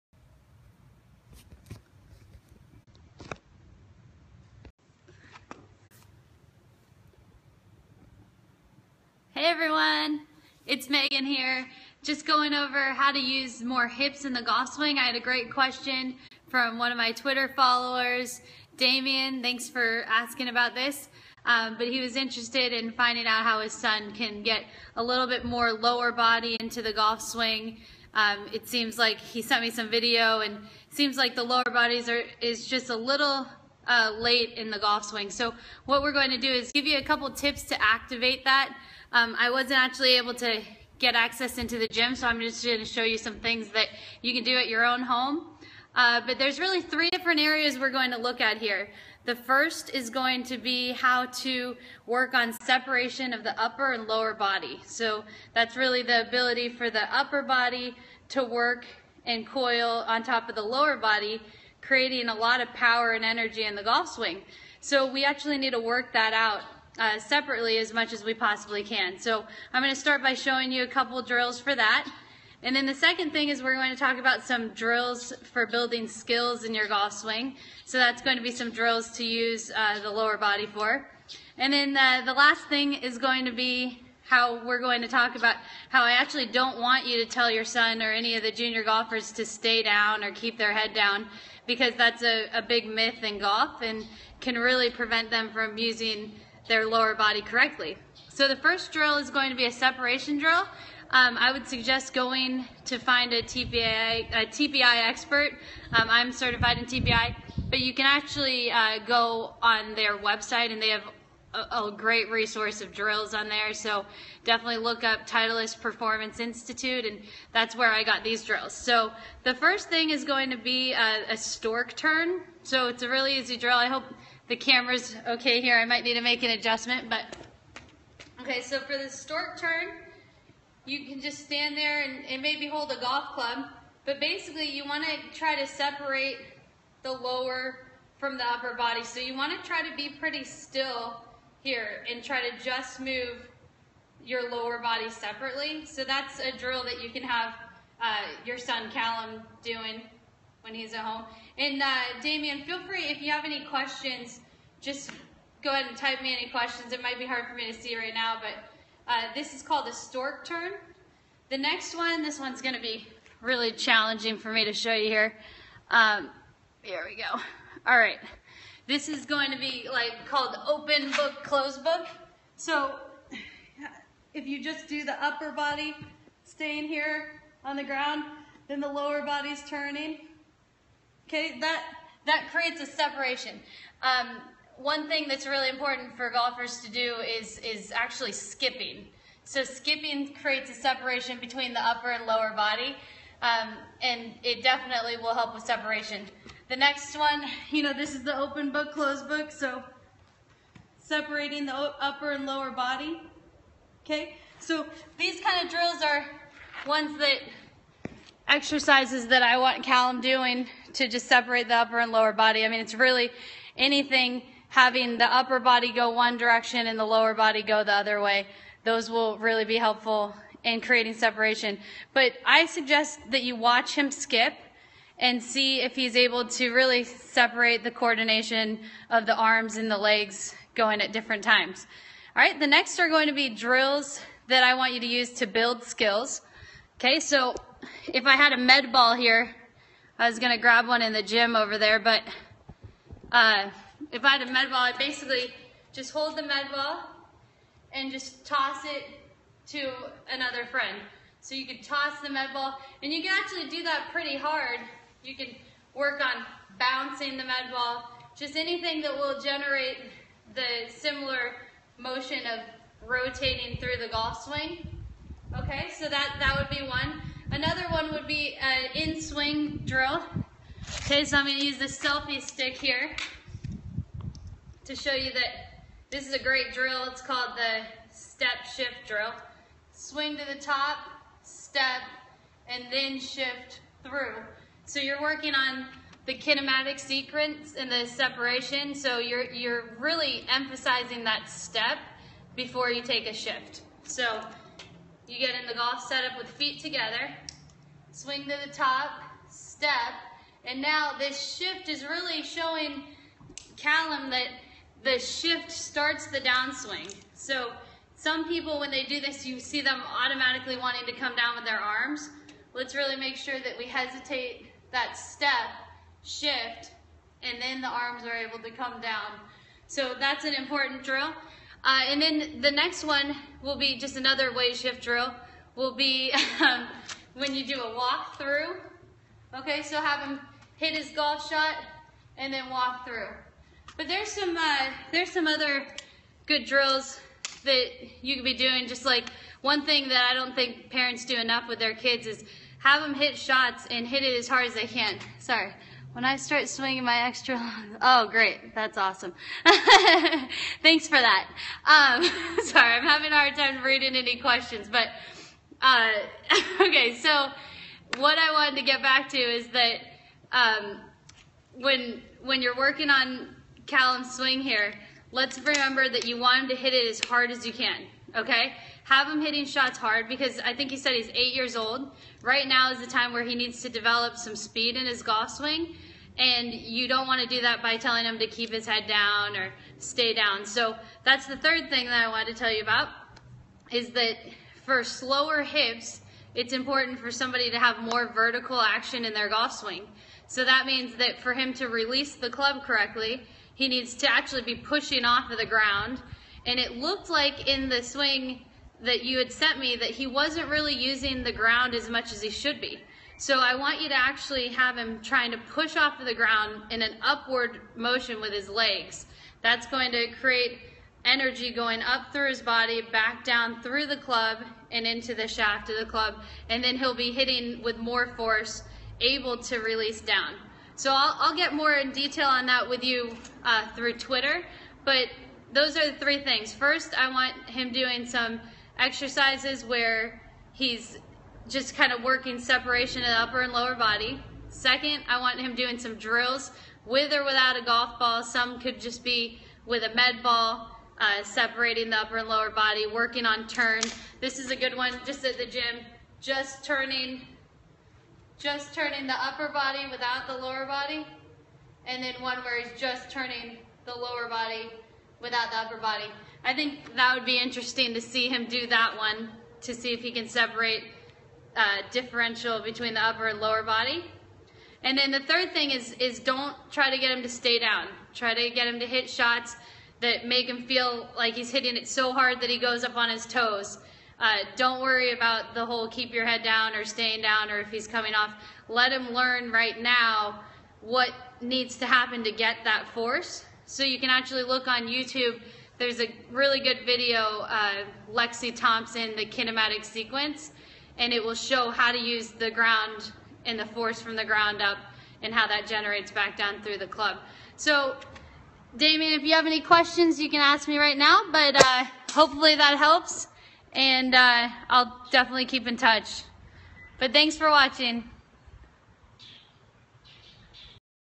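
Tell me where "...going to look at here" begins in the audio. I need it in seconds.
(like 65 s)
47 s.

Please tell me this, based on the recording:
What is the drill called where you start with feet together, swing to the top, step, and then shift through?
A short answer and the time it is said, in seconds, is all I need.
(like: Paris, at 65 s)
Step shift drill, at 278 s.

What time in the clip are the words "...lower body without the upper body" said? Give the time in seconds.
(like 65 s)
454 s.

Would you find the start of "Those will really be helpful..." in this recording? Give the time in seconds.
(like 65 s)
218 s.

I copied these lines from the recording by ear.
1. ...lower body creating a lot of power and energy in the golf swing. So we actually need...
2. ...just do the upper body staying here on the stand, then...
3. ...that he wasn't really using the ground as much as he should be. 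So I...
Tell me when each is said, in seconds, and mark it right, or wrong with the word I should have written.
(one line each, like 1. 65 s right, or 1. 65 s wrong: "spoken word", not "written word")
1. 60 s right
2. 174 s wrong: "ground", not "stand"
3. 399 s right.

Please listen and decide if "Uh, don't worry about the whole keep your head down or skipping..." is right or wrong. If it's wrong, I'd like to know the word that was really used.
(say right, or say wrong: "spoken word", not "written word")
wrong: "staying", not "skipping".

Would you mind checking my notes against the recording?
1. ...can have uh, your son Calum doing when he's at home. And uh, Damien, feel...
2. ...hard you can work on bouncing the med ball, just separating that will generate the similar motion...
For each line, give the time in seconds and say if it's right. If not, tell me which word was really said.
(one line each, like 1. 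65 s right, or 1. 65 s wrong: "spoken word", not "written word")
1. 147 s right
2. 254 s wrong: "anything", not "separating".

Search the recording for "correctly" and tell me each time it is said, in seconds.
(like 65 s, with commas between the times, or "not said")
97 s, 392 s.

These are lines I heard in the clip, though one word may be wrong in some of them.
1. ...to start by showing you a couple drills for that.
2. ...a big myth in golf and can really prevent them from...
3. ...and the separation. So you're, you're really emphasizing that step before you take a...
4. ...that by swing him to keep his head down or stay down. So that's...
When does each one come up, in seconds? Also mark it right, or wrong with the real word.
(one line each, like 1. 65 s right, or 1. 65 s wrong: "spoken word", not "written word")
1. 69 s right
2. 92 s right
3. 287 s right
4. 377 s wrong: "telling", not "swing".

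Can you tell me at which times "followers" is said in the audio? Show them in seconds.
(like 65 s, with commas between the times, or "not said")
17 s.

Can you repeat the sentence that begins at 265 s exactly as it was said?
Okay, so that, that would be one.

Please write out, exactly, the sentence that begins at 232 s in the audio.
All right, the next are going to be drills that I want you to use to build skills.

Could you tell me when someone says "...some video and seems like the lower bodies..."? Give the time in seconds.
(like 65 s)
29 s.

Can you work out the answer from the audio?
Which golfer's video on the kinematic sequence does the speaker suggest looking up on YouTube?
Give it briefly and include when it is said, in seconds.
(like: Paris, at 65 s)
Lexi Thompson, at 488 s.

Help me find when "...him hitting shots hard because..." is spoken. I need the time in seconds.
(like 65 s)
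369 s.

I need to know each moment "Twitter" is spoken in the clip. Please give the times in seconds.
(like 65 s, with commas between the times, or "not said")
17 s, 424 s.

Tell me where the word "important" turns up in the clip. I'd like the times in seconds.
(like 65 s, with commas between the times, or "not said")
185 s, 320 s, 386 s.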